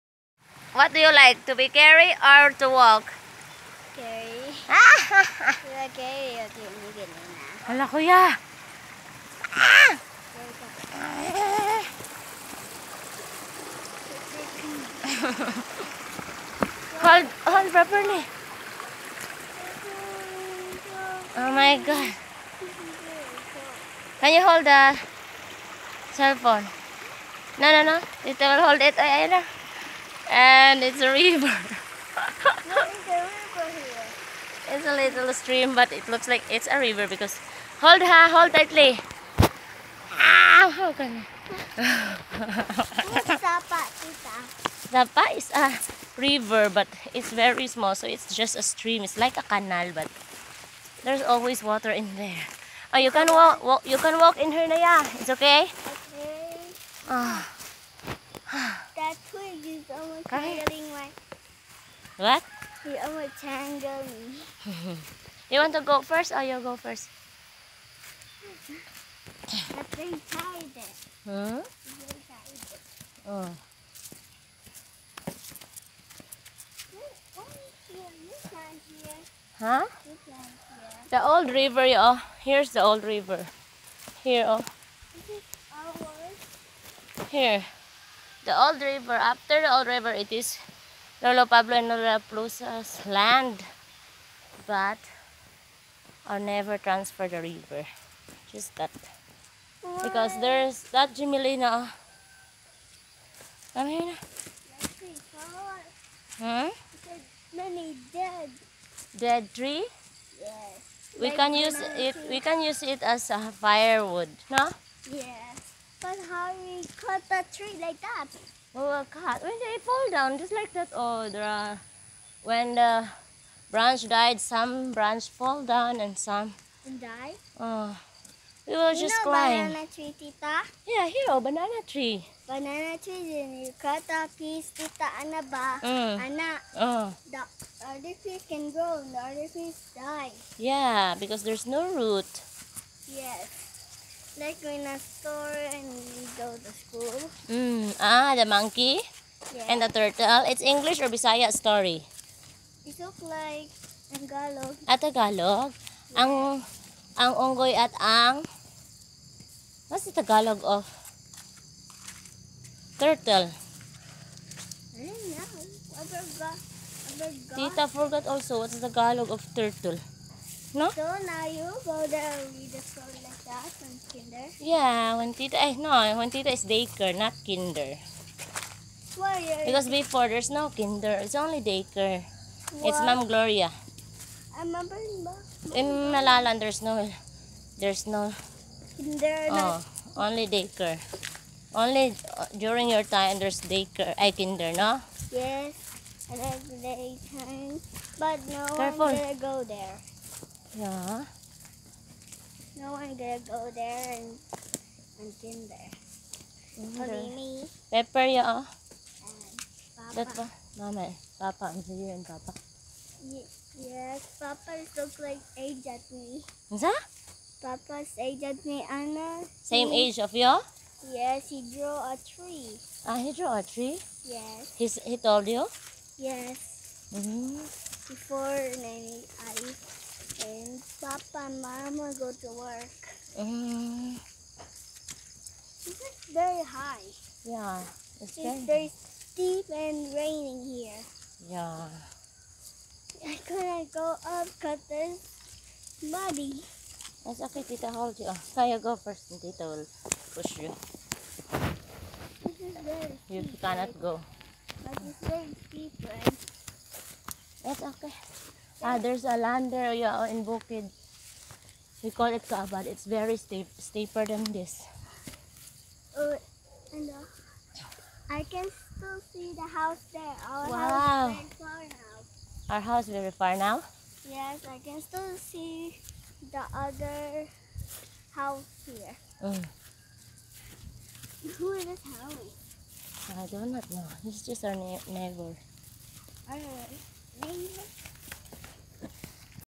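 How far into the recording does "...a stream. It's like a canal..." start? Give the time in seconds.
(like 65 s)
48 s.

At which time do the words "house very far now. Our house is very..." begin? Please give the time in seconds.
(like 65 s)
271 s.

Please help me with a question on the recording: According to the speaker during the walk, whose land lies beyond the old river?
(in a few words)
Lolo Pablo and Lolo Plusa.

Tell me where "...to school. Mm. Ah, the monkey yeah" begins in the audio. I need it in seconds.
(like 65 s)
146 s.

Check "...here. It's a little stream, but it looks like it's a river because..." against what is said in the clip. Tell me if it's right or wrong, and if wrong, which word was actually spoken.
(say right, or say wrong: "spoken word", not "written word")
right.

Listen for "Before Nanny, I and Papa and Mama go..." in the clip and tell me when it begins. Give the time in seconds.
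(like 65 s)
228 s.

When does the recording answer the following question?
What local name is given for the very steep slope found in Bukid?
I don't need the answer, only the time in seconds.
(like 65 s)
262 s.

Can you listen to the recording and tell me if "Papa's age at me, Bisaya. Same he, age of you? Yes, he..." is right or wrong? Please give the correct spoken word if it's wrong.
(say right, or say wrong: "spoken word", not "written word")
wrong: "Anna", not "Bisaya".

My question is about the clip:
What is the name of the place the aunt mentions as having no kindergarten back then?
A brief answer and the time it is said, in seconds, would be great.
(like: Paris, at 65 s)
Malalan, at 186 s.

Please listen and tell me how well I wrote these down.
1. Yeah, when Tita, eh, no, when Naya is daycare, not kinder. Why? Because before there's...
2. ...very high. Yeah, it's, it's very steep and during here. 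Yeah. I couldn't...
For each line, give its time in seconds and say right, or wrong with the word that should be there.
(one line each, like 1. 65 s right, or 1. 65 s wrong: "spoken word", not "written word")
1. 174 s wrong: "Tita", not "Naya"
2. 236 s wrong: "raining", not "during".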